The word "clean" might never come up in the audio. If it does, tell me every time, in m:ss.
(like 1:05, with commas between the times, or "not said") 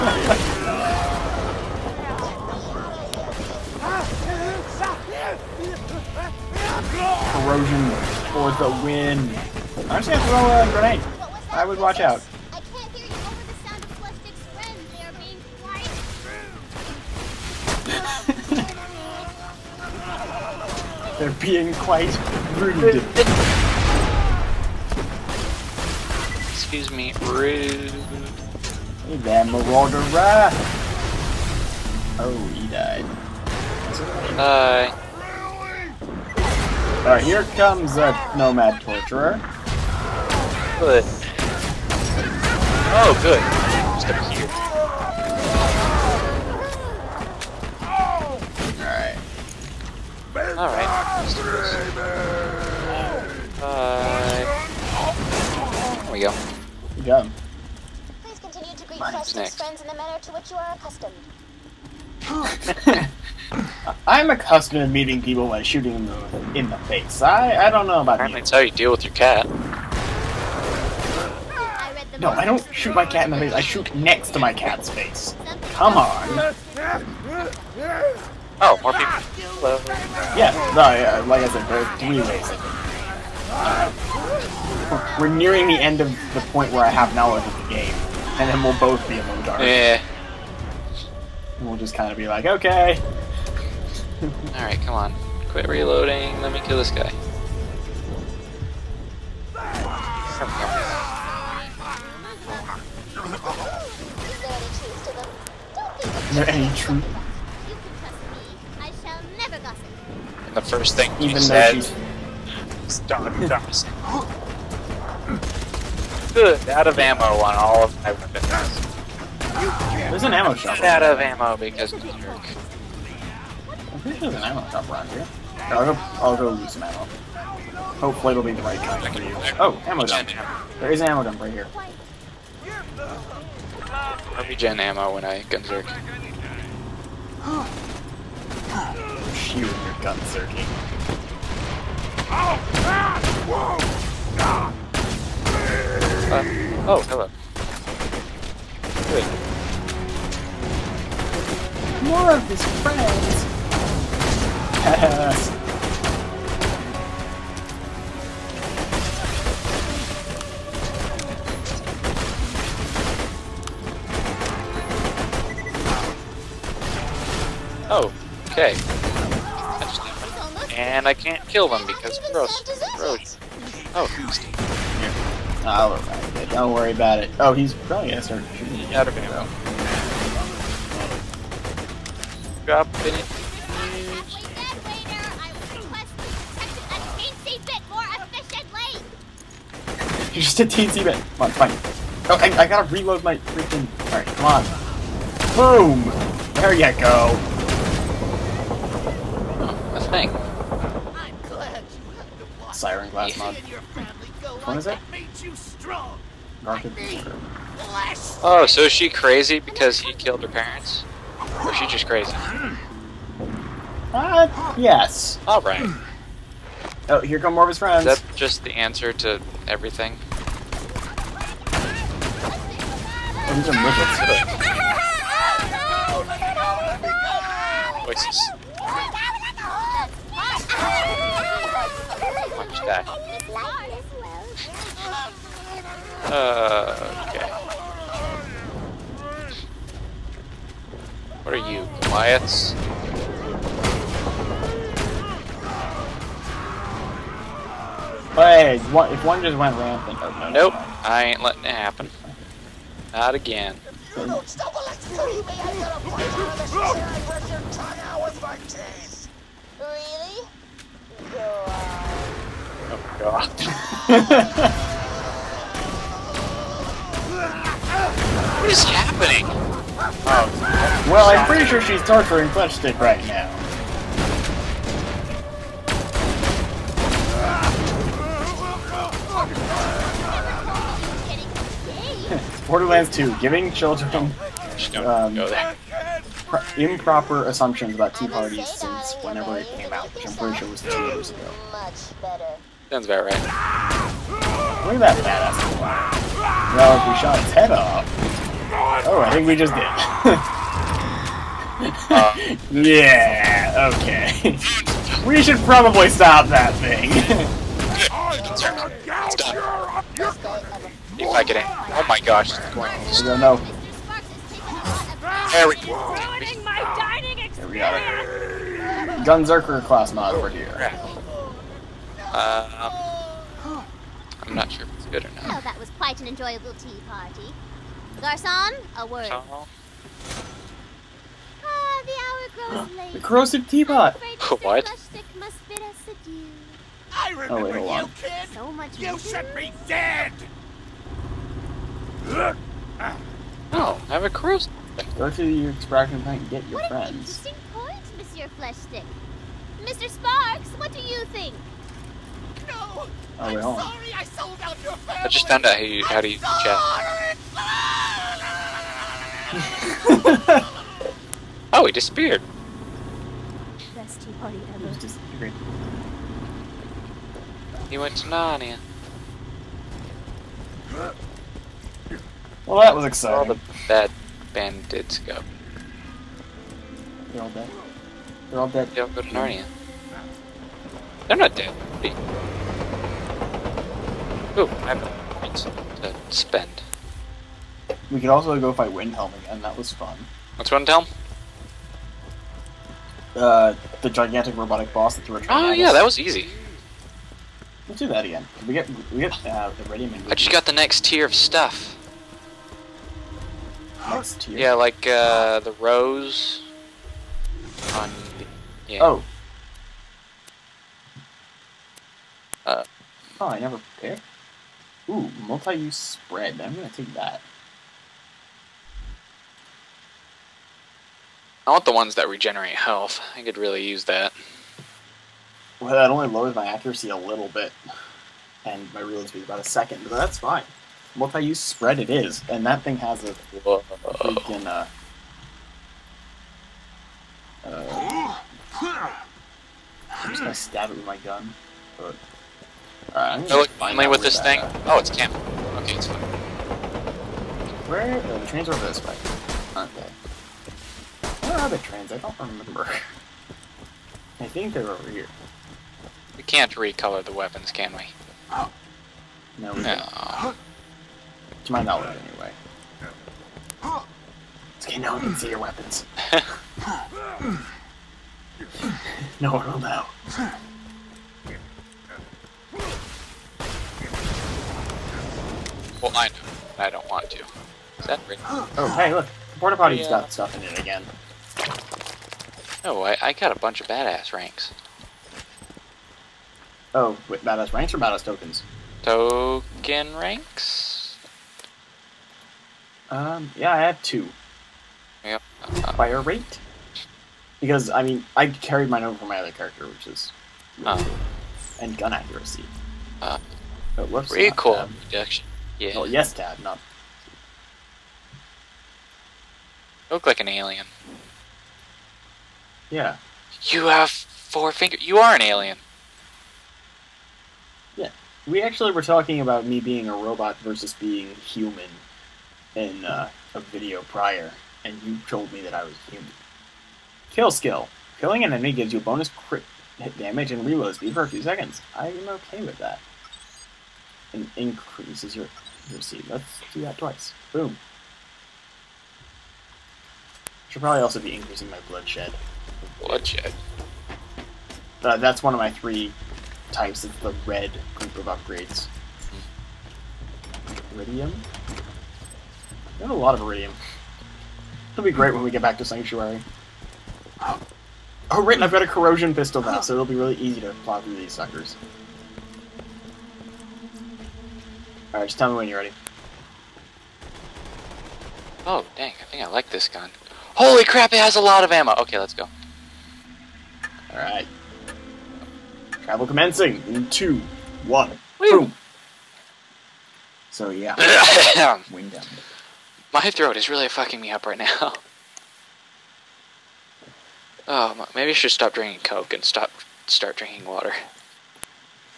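not said.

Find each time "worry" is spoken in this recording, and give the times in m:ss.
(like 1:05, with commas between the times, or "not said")
2:56.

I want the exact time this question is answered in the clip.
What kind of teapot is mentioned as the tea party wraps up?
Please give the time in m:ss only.
5:33.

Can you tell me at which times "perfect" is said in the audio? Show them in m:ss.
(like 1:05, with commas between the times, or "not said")
not said.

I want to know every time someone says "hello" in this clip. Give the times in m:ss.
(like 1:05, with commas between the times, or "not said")
1:19, 2:27.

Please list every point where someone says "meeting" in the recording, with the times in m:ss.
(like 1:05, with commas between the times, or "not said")
1:04.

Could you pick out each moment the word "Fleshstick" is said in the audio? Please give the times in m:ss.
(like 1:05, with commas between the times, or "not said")
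4:32, 5:48.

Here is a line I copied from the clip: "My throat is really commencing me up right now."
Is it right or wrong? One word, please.
wrong.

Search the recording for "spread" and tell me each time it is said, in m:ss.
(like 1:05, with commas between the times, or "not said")
6:55, 7:11.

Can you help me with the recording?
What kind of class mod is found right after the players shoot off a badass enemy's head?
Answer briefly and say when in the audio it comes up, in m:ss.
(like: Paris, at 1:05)
Gunzerker class mod, at 5:19.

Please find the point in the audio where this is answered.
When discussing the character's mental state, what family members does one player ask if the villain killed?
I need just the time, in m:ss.
3:30.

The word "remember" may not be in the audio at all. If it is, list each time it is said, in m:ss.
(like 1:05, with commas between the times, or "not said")
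5:37, 7:32.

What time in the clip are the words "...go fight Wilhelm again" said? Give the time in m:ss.
6:28.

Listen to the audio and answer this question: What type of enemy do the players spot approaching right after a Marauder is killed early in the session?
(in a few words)
Nomad Torturer.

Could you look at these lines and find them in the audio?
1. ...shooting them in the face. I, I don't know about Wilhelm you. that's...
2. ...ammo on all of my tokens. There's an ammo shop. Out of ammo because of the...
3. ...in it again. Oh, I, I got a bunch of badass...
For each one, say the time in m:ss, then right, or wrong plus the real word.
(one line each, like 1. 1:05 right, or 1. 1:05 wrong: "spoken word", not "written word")
1. 1:05 wrong: "Apparently", not "Wilhelm"
2. 1:56 wrong: "weapons", not "tokens"
3. 8:00 right.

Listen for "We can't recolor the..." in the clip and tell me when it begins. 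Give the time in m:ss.
7:36.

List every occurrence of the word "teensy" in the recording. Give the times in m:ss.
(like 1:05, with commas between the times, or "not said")
3:10.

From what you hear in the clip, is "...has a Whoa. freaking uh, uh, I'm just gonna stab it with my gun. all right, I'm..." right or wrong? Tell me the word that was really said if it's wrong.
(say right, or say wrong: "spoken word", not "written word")
right.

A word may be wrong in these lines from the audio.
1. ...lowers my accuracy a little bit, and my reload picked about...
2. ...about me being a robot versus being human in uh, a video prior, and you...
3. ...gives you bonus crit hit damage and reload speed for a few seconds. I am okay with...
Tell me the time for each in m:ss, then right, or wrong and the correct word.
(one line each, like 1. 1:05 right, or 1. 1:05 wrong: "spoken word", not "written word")
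1. 7:06 wrong: "speed", not "picked"
2. 8:39 right
3. 8:48 right.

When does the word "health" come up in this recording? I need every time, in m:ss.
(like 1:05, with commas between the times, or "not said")
7:02.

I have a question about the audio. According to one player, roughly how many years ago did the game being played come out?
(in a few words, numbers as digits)
2.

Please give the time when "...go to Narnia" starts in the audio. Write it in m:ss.
6:19.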